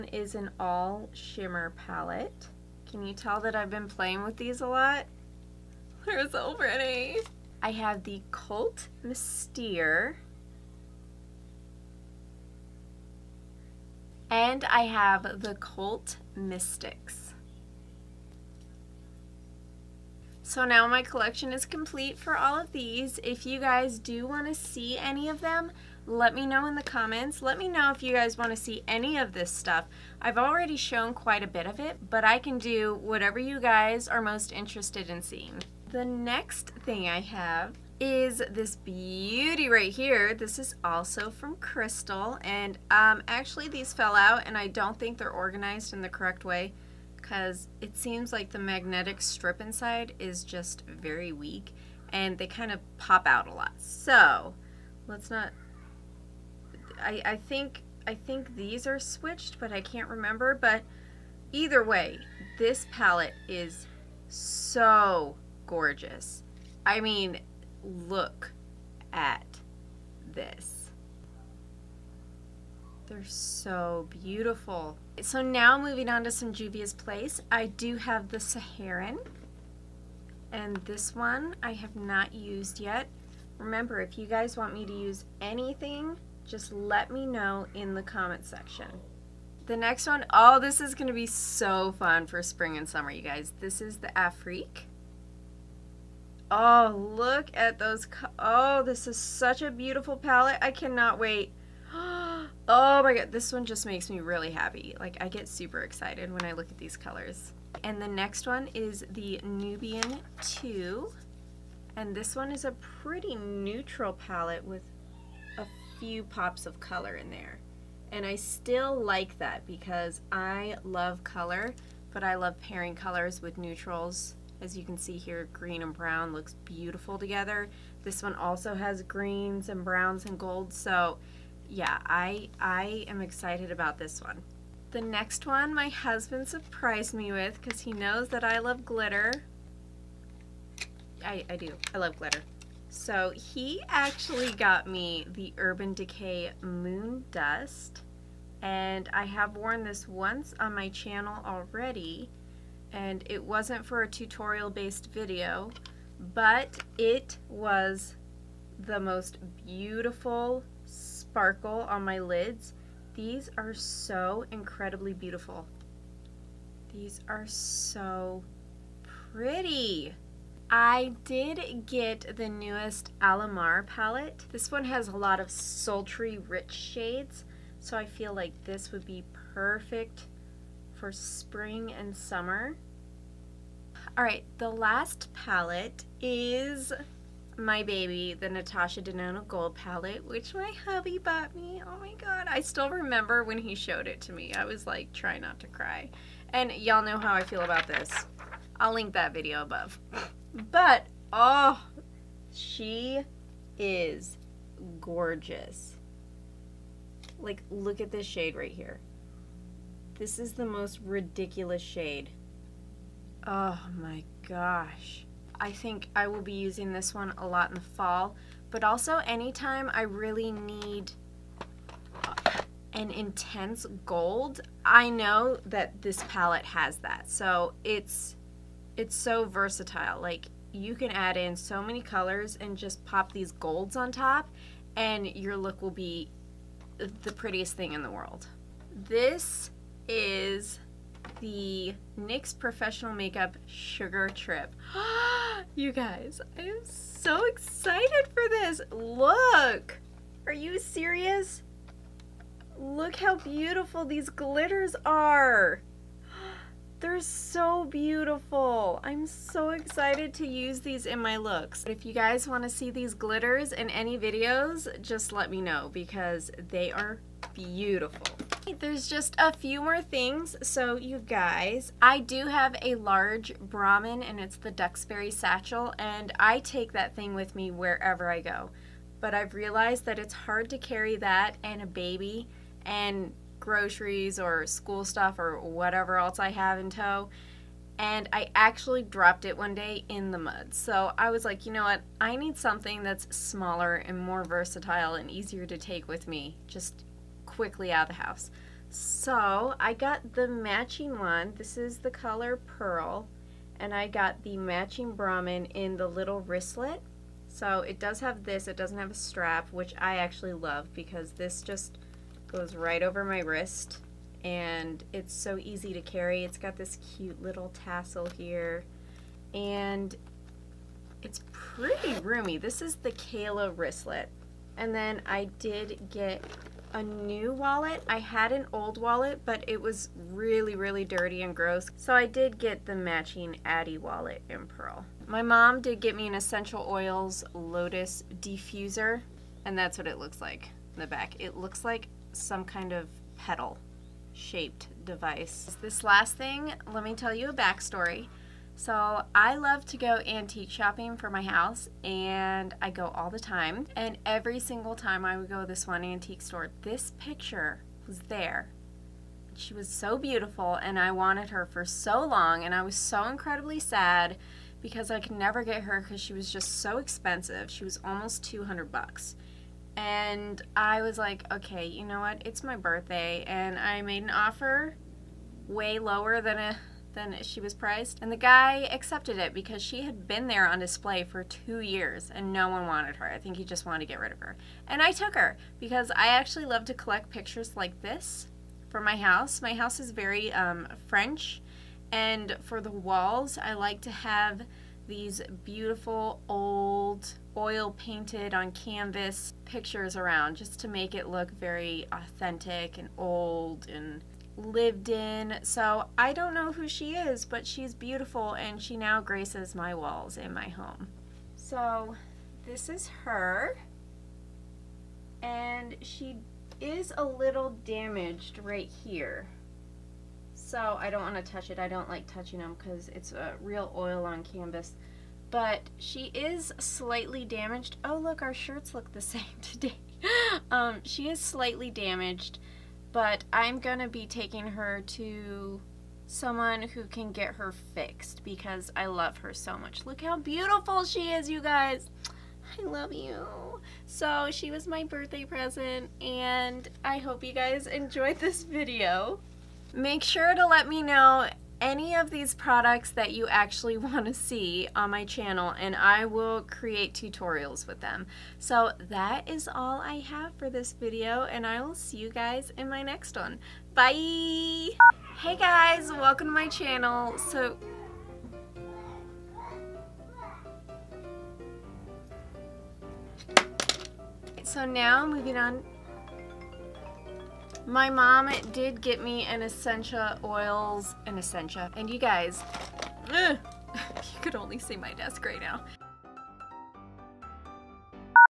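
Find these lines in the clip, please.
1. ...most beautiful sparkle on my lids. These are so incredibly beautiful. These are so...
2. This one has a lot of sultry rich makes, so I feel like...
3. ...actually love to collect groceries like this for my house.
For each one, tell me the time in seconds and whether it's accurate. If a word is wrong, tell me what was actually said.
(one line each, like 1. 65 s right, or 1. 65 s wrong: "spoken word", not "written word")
1. 158 s right
2. 174 s wrong: "shades", not "makes"
3. 386 s wrong: "pictures", not "groceries".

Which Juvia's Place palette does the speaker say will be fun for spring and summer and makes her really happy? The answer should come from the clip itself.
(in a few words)
Afrique.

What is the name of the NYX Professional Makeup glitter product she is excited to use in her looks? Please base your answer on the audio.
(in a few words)
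Sugar Trip.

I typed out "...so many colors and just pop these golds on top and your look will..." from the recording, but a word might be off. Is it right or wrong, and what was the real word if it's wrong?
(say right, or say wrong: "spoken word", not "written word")
right.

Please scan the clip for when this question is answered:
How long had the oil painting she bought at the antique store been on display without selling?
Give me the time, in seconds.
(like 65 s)
381 s.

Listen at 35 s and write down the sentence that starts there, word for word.
The next thing I have is this beauty right here.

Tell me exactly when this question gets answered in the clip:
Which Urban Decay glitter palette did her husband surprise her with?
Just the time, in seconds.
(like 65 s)
146 s.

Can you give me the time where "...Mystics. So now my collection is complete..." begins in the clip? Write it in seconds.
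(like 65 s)
16 s.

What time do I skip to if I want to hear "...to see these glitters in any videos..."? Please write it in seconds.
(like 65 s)
262 s.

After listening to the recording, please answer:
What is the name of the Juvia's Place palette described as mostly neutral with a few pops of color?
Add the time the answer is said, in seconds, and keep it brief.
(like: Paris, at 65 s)
Nubian 2, at 109 s.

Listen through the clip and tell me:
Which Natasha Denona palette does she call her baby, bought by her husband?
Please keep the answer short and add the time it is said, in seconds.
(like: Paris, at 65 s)
Gold palette, at 189 s.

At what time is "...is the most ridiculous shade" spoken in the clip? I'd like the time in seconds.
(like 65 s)
210 s.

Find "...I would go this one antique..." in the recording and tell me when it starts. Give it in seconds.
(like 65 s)
355 s.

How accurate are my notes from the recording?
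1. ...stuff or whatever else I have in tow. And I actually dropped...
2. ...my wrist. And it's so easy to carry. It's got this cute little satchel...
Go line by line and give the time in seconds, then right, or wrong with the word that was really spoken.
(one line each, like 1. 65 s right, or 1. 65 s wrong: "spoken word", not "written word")
1. 285 s right
2. 313 s wrong: "tassel", not "satchel".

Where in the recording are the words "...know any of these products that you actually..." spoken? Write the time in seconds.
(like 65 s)
451 s.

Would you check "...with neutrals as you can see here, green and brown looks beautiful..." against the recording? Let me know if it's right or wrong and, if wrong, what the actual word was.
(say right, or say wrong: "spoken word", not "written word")
right.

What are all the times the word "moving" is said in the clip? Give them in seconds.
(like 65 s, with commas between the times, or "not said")
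75 s, 475 s.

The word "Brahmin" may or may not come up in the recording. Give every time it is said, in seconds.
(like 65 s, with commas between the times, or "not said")
273 s, 305 s.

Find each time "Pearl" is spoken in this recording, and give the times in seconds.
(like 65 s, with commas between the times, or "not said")
302 s, 334 s.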